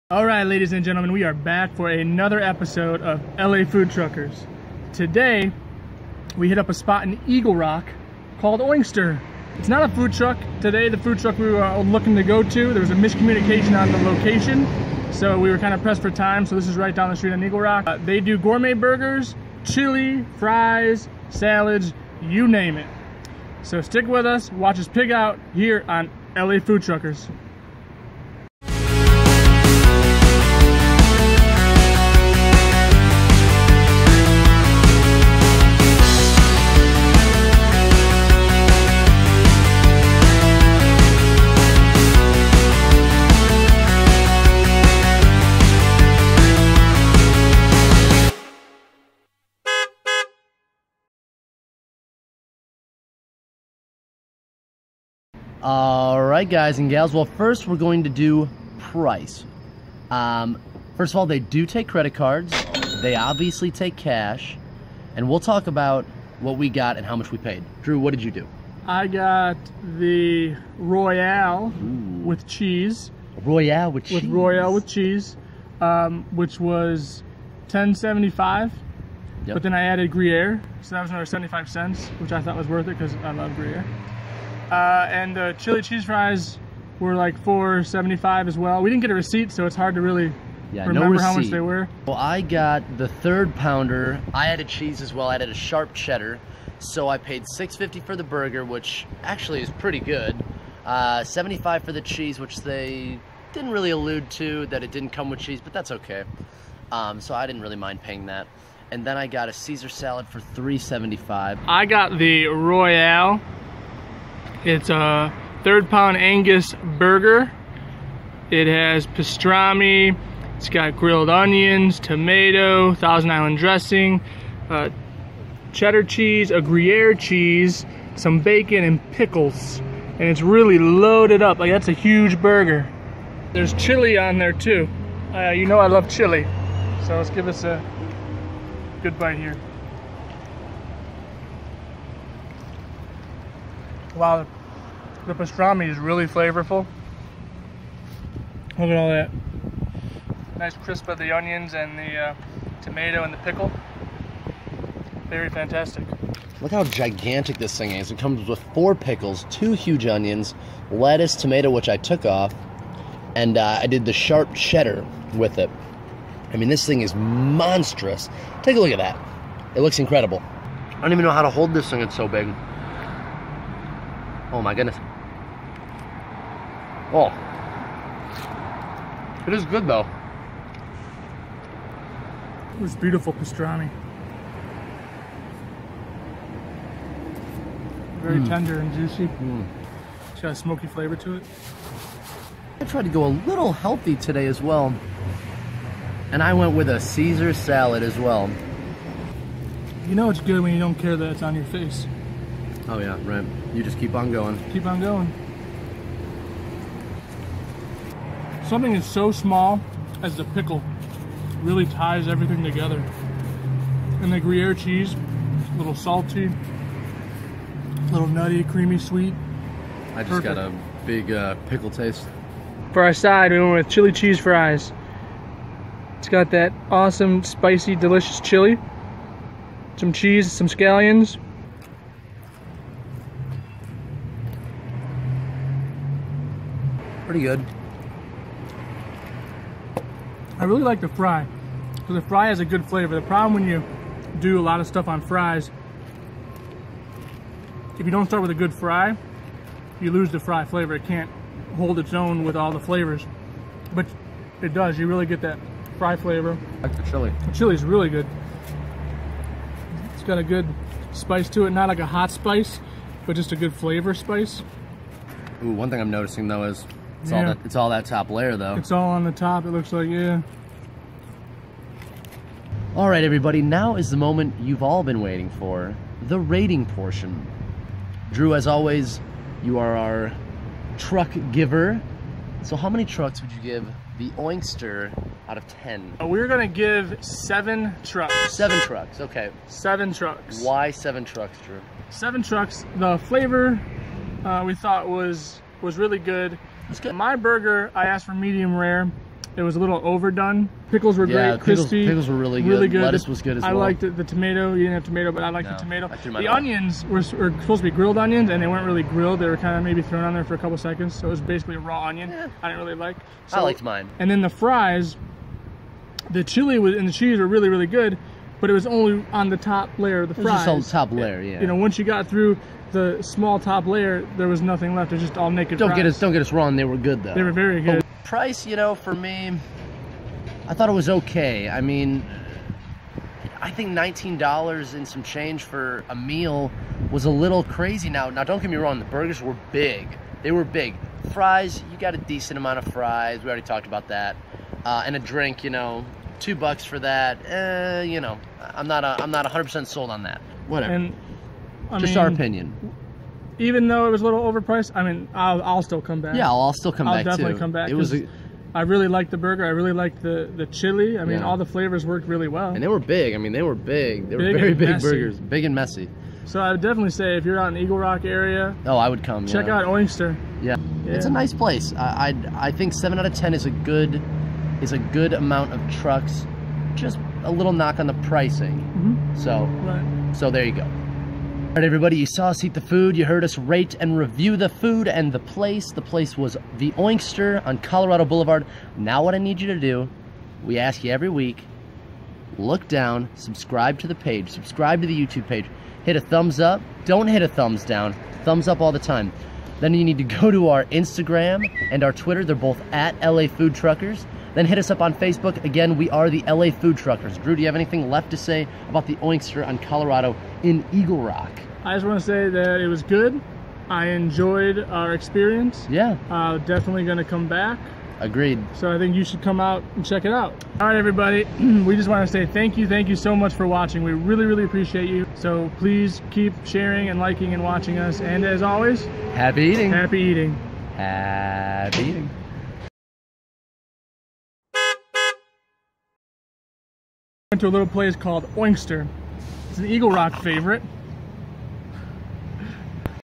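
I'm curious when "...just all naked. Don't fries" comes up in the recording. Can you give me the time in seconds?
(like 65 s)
325 s.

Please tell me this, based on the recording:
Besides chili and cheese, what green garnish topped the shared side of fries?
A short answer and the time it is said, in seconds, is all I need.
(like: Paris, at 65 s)
scallions, at 230 s.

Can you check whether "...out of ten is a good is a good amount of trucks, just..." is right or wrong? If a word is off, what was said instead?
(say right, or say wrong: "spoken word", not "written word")
right.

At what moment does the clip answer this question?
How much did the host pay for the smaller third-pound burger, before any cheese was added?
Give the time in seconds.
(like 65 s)
97 s.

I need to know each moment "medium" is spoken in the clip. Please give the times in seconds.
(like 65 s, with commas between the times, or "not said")
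298 s.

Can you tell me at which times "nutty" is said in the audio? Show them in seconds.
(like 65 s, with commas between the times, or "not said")
218 s.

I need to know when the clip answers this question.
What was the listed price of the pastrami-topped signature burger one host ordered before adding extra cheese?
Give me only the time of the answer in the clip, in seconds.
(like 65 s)
77 s.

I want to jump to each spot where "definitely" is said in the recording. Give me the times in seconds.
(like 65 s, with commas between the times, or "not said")
357 s, 366 s, 416 s.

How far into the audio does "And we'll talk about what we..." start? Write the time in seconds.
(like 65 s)
65 s.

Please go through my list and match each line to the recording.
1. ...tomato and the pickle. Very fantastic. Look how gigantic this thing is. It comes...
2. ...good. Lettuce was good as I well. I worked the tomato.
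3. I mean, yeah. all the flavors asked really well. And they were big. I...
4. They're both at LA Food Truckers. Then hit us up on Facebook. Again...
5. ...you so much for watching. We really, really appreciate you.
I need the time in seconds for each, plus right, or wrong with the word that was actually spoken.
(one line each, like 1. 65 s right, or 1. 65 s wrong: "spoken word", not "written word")
1. 152 s right
2. 302 s wrong: "liked", not "worked"
3. 361 s wrong: "worked", not "asked"
4. 402 s right
5. 423 s right.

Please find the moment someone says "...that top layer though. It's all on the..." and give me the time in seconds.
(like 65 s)
267 s.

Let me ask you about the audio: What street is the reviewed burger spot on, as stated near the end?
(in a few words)
Colorado Boulevard.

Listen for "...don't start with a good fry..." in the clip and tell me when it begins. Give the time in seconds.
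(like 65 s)
248 s.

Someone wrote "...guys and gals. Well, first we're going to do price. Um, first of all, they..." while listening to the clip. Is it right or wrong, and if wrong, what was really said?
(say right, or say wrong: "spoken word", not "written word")
right.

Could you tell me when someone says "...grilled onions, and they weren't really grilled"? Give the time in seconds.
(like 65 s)
307 s.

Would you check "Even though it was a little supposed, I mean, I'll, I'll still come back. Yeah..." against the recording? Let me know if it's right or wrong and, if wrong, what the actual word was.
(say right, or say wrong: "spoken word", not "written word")
wrong: "overpriced", not "supposed".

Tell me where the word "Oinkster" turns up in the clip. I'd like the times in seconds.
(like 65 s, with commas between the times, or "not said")
8 s, 284 s, 369 s, 386 s, 409 s, 438 s.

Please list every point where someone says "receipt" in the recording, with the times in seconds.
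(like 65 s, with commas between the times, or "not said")
89 s.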